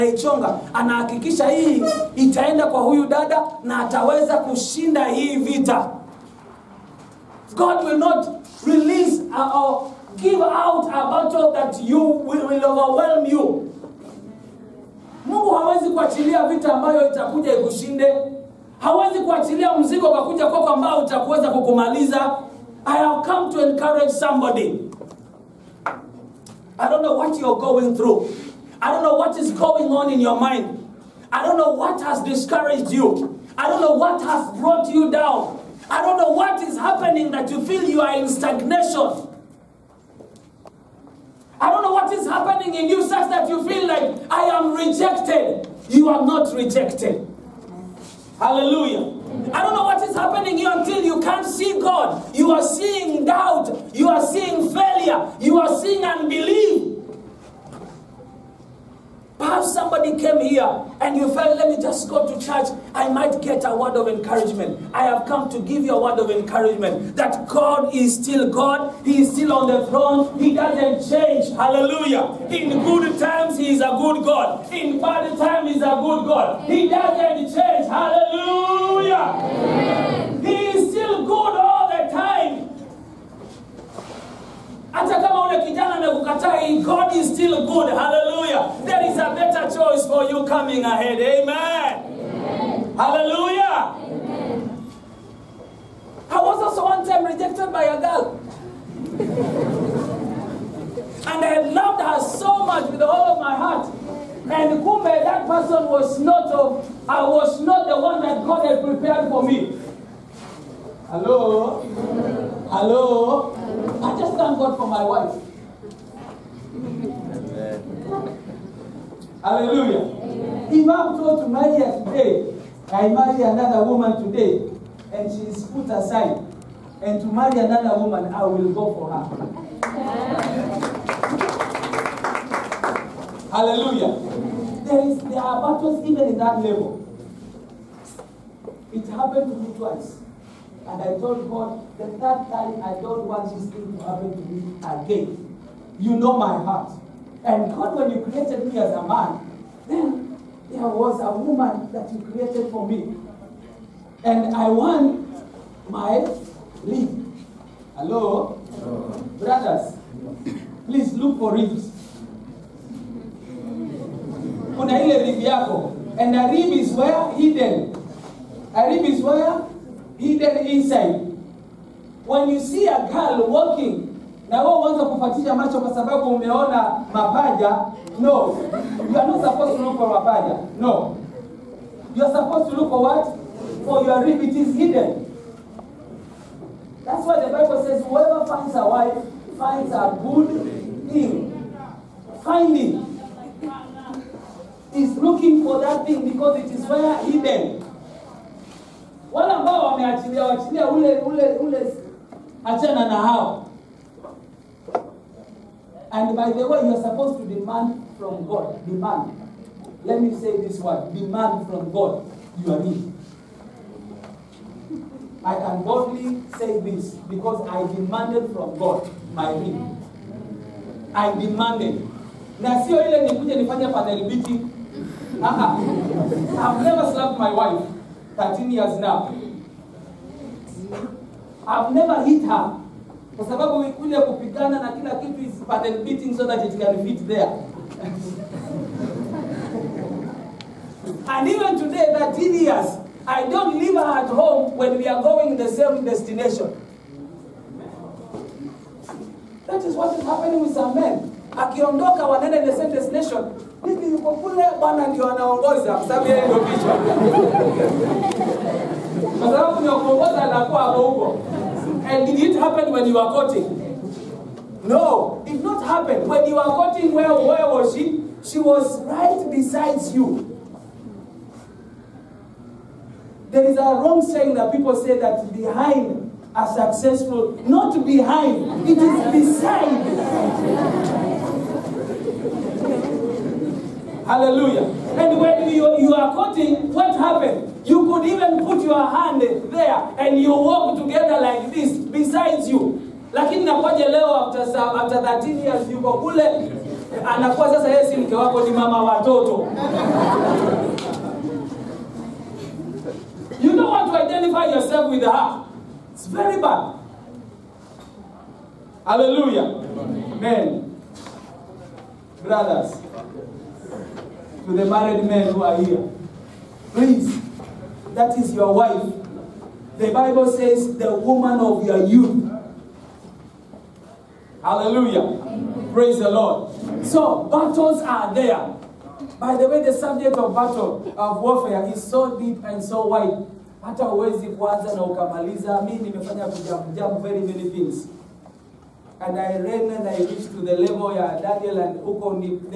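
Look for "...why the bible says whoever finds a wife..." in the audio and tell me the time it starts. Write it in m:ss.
3:07.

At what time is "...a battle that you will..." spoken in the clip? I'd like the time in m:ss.
0:10.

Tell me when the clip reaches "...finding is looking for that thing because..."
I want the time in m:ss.
3:12.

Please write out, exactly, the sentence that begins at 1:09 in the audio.
He is still on the throne.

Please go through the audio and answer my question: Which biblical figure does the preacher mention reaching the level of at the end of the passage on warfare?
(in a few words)
Daniel.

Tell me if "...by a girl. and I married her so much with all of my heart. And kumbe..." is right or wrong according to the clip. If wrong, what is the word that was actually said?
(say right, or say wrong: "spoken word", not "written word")
wrong: "loved", not "married".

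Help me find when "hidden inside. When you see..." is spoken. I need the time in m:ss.
2:50.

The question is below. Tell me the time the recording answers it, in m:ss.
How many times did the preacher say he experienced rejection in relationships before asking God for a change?
2:19.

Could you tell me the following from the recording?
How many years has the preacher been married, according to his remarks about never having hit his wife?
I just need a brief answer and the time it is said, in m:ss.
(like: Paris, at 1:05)
13, at 3:48.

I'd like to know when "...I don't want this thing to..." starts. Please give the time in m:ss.
2:22.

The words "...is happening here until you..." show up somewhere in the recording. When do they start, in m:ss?
0:50.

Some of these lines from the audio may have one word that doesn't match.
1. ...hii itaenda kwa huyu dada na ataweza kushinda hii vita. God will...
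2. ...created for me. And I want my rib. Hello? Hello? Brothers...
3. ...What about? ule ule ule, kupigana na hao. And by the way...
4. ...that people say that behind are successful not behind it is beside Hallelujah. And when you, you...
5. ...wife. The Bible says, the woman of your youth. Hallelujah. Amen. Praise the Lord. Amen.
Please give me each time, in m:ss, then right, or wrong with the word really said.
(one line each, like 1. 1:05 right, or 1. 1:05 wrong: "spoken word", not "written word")
1. 0:01 right
2. 2:32 right
3. 3:19 wrong: "achana", not "kupigana"
4. 4:34 right
5. 5:18 right.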